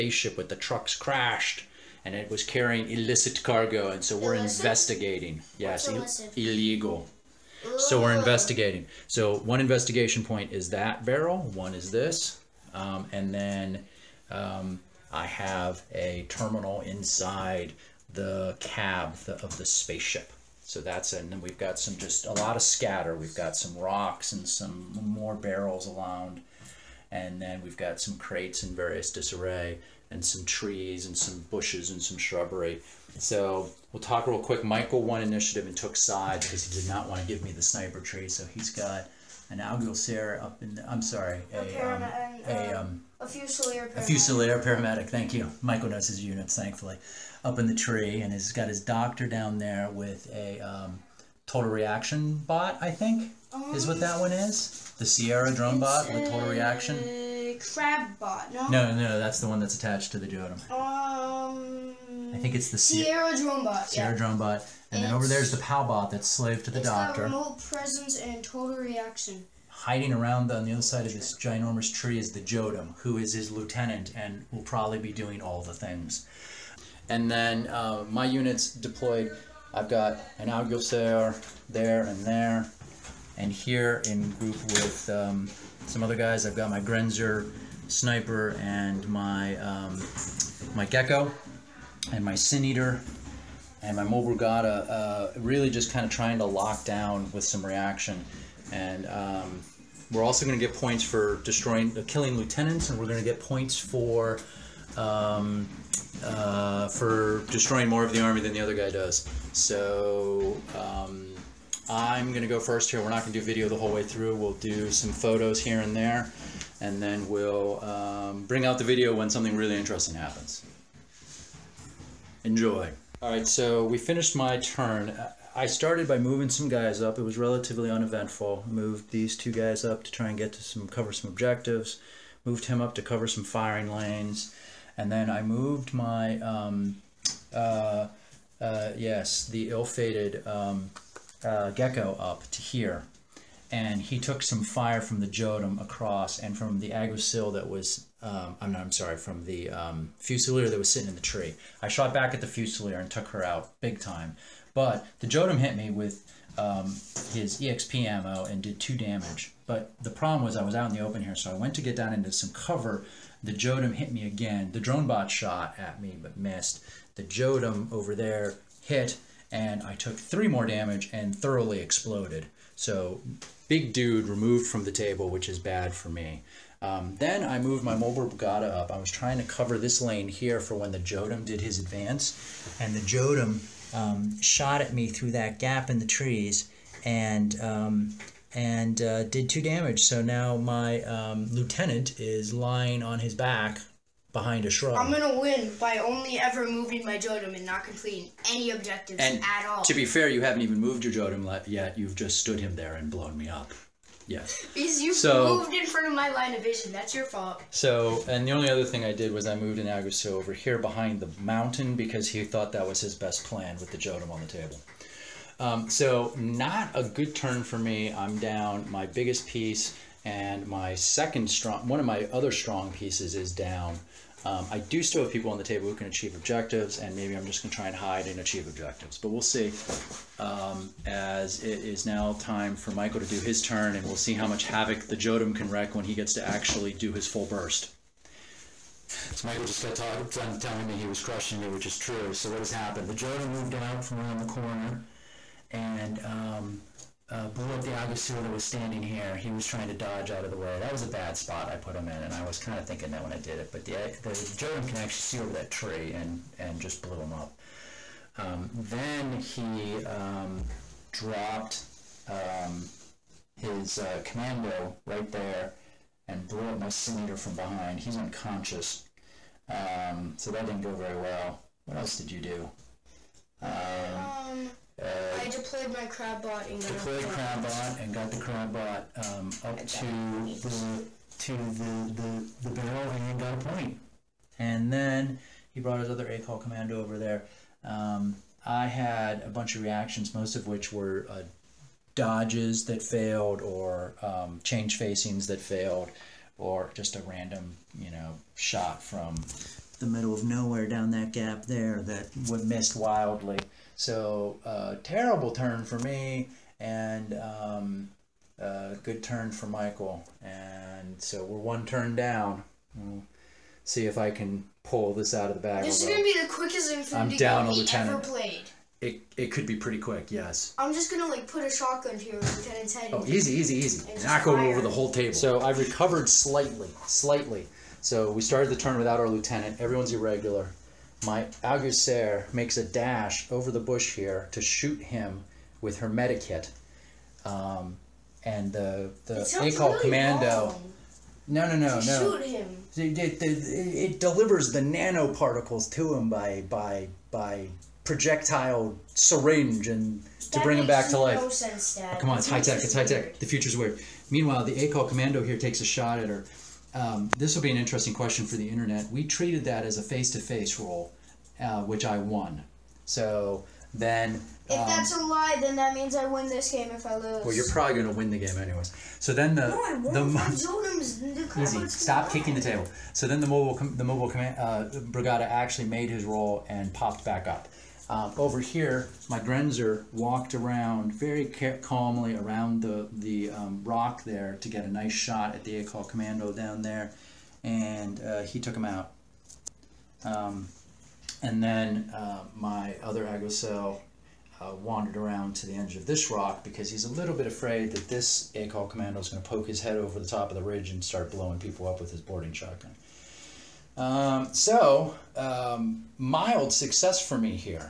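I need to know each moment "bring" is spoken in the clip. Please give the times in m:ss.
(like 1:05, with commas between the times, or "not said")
1:58, 5:50.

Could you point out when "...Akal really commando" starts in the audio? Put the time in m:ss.
5:39.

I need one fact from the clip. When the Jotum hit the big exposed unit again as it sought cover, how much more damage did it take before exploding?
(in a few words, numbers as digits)
3.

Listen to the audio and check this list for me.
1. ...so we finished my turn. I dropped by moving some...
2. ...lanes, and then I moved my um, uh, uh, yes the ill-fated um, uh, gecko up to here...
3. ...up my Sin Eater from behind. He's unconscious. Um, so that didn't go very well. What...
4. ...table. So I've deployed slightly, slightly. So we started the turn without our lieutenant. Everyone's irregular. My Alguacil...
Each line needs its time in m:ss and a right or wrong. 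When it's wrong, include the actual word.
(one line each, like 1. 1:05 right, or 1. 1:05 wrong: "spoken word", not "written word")
1. 2:03 wrong: "started", not "dropped"
2. 2:13 right
3. 4:26 right
4. 5:25 wrong: "recovered", not "deployed".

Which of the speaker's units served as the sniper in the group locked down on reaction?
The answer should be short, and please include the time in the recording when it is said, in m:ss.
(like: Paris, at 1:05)
Grenzer sniper, at 1:26.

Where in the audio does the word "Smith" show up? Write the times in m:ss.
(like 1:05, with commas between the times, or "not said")
not said.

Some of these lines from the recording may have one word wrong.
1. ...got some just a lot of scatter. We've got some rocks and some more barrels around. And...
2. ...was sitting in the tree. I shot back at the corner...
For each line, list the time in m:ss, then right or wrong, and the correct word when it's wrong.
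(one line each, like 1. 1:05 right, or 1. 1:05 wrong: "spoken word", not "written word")
1. 0:21 right
2. 2:30 wrong: "fusilier", not "corner".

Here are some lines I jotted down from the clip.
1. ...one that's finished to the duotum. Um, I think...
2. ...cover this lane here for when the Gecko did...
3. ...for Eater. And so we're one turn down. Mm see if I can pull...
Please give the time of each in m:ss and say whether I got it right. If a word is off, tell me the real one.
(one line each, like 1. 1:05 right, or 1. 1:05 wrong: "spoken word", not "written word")
1. 0:59 wrong: "attached", not "finished"
2. 2:59 wrong: "Jotum", not "Gecko"
3. 5:09 wrong: "Michael", not "Eater".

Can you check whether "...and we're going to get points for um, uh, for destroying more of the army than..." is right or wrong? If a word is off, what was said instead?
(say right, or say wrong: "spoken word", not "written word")
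right.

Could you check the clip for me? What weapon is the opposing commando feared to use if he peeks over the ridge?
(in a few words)
Boarding shotgun.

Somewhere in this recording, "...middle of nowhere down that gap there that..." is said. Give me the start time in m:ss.
5:00.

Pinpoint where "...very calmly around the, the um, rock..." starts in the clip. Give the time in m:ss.
6:21.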